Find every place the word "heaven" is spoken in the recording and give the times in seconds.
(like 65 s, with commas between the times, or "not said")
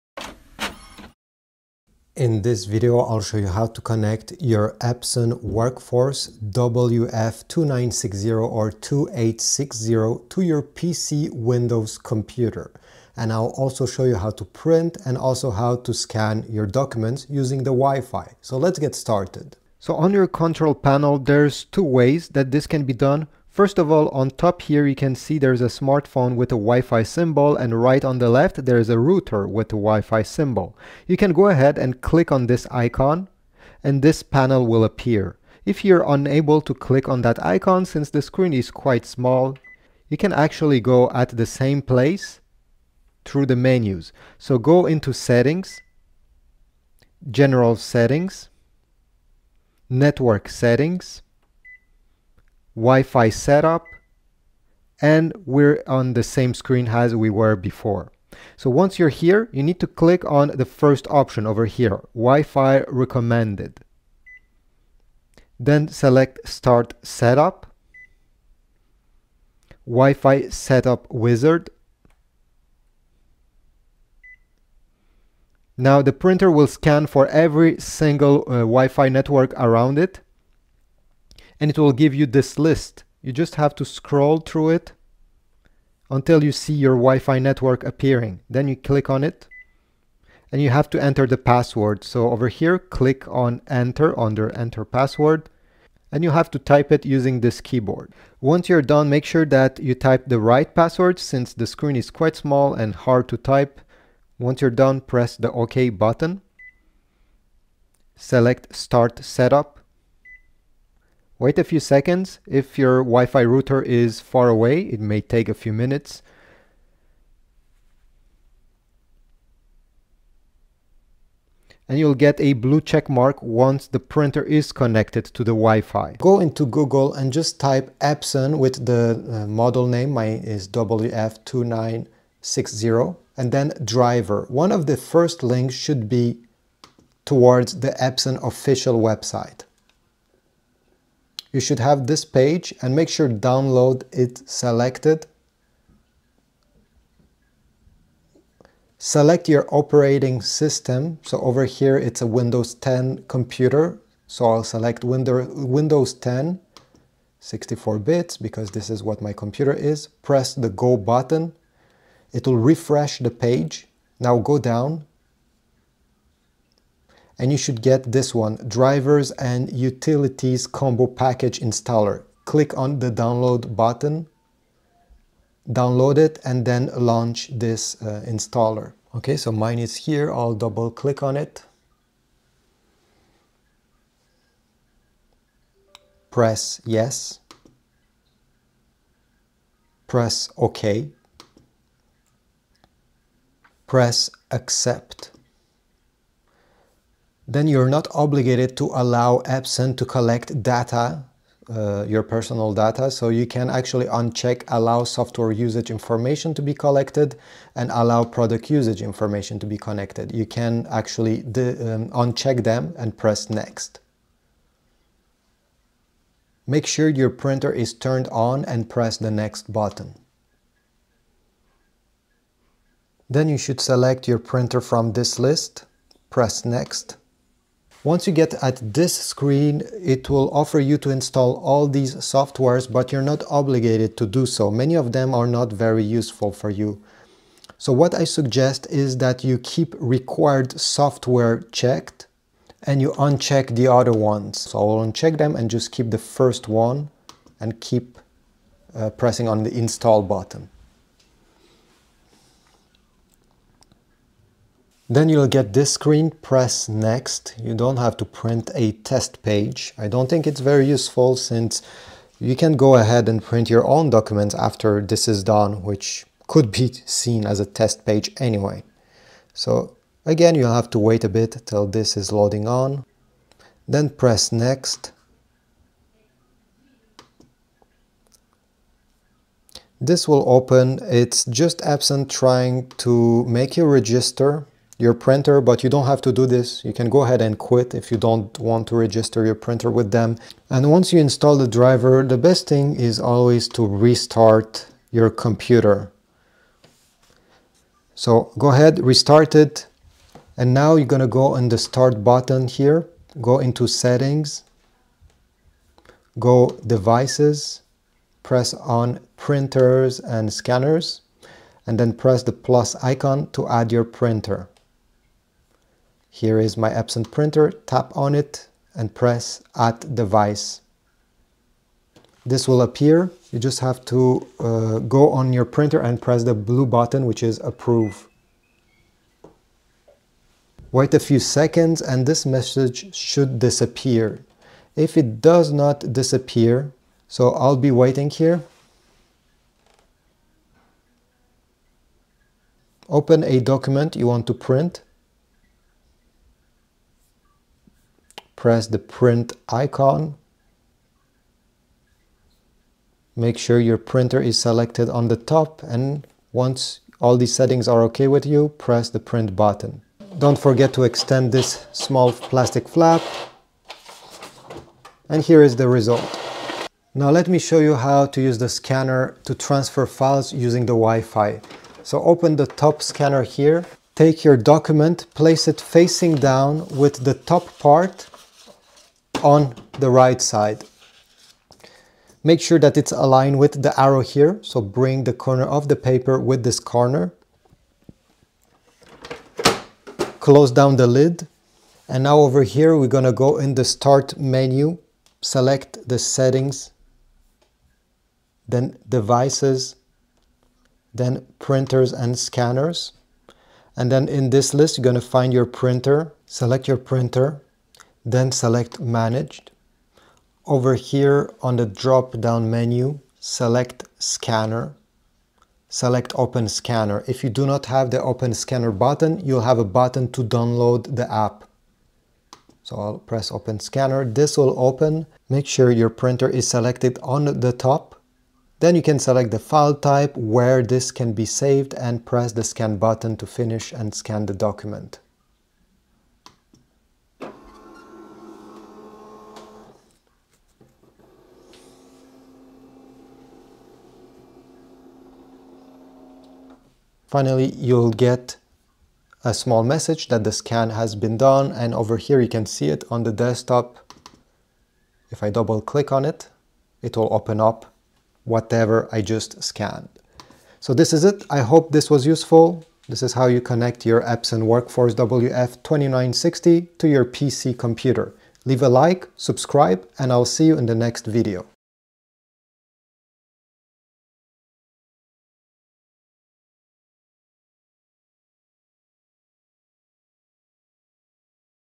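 not said.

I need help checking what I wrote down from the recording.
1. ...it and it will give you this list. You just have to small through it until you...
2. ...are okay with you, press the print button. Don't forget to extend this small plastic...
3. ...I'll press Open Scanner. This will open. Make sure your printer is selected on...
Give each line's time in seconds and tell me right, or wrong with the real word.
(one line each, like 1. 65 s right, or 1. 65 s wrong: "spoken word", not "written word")
1. 79 s wrong: "scroll", not "small"
2. 357 s right
3. 422 s right.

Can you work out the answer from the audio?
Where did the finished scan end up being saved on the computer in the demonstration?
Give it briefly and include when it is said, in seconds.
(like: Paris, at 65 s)
The desktop, at 453 s.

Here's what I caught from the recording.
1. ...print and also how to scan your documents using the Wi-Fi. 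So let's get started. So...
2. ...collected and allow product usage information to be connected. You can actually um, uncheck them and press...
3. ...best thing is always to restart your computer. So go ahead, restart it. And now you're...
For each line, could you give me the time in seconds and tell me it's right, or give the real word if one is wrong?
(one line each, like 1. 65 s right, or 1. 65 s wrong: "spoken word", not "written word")
1. 14 s right
2. 206 s right
3. 292 s right.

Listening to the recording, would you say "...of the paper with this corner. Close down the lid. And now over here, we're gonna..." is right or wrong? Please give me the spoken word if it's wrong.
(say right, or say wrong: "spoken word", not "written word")
right.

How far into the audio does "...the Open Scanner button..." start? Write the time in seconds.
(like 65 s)
418 s.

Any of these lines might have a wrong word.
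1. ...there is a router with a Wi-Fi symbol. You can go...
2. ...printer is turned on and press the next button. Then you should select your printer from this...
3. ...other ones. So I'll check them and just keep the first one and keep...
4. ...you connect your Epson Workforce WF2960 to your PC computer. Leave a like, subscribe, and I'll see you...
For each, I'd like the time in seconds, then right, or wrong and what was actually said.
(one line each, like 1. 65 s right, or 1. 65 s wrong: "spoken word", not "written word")
1. 28 s right
2. 217 s right
3. 243 s wrong: "uncheck", not "check"
4. 463 s right.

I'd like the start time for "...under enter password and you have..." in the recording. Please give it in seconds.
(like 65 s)
94 s.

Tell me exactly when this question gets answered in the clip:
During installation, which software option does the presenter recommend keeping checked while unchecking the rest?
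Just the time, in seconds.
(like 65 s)
239 s.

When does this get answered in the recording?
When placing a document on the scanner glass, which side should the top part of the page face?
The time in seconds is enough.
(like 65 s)
380 s.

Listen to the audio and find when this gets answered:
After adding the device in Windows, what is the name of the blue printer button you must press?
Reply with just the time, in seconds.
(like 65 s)
327 s.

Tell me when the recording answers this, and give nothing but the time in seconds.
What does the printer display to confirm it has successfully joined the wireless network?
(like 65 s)
122 s.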